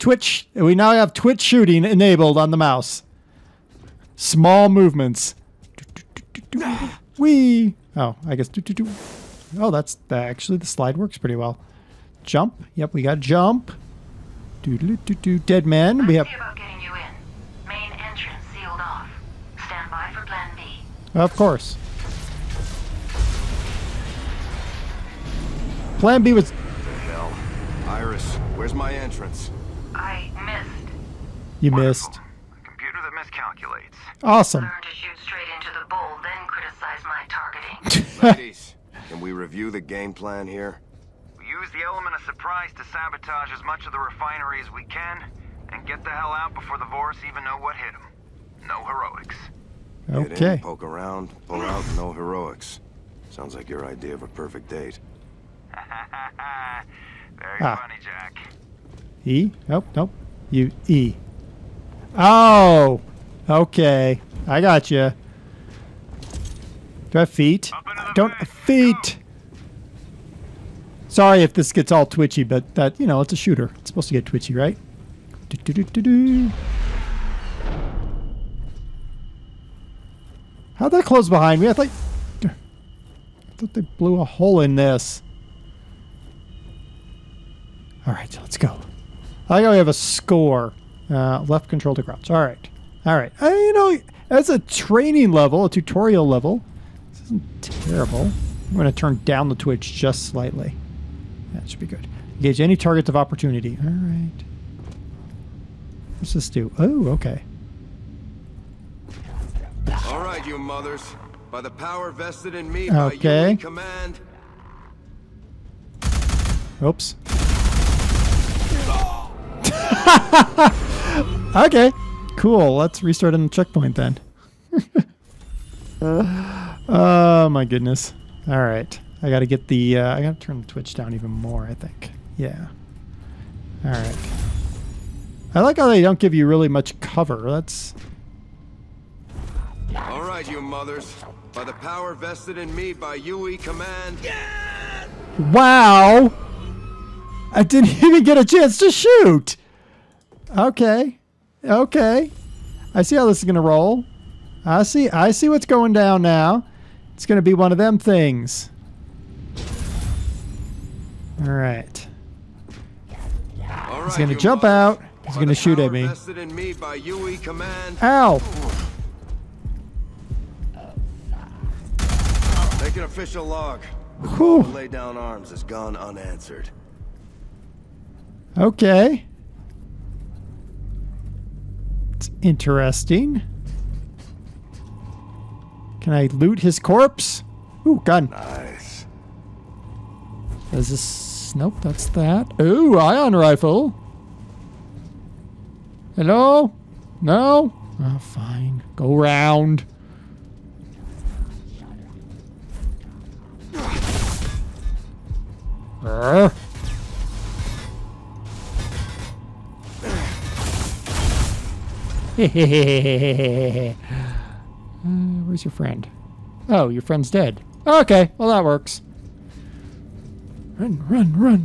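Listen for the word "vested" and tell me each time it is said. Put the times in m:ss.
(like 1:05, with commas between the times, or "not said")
1:52, 2:22.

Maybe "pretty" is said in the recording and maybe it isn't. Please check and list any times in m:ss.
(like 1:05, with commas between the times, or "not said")
0:11.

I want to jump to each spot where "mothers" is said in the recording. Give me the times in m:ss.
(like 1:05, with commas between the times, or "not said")
1:50, 2:20.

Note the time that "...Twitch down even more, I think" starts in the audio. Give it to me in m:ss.
2:10.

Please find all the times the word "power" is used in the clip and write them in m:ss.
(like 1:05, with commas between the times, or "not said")
1:51, 2:21.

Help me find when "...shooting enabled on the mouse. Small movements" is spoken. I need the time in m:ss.
0:01.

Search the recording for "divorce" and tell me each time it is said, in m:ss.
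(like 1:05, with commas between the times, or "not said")
not said.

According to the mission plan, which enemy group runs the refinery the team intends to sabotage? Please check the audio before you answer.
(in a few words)
Vorus.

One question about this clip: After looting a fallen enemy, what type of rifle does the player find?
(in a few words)
ion rifle.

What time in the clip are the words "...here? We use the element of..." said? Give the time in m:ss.
0:40.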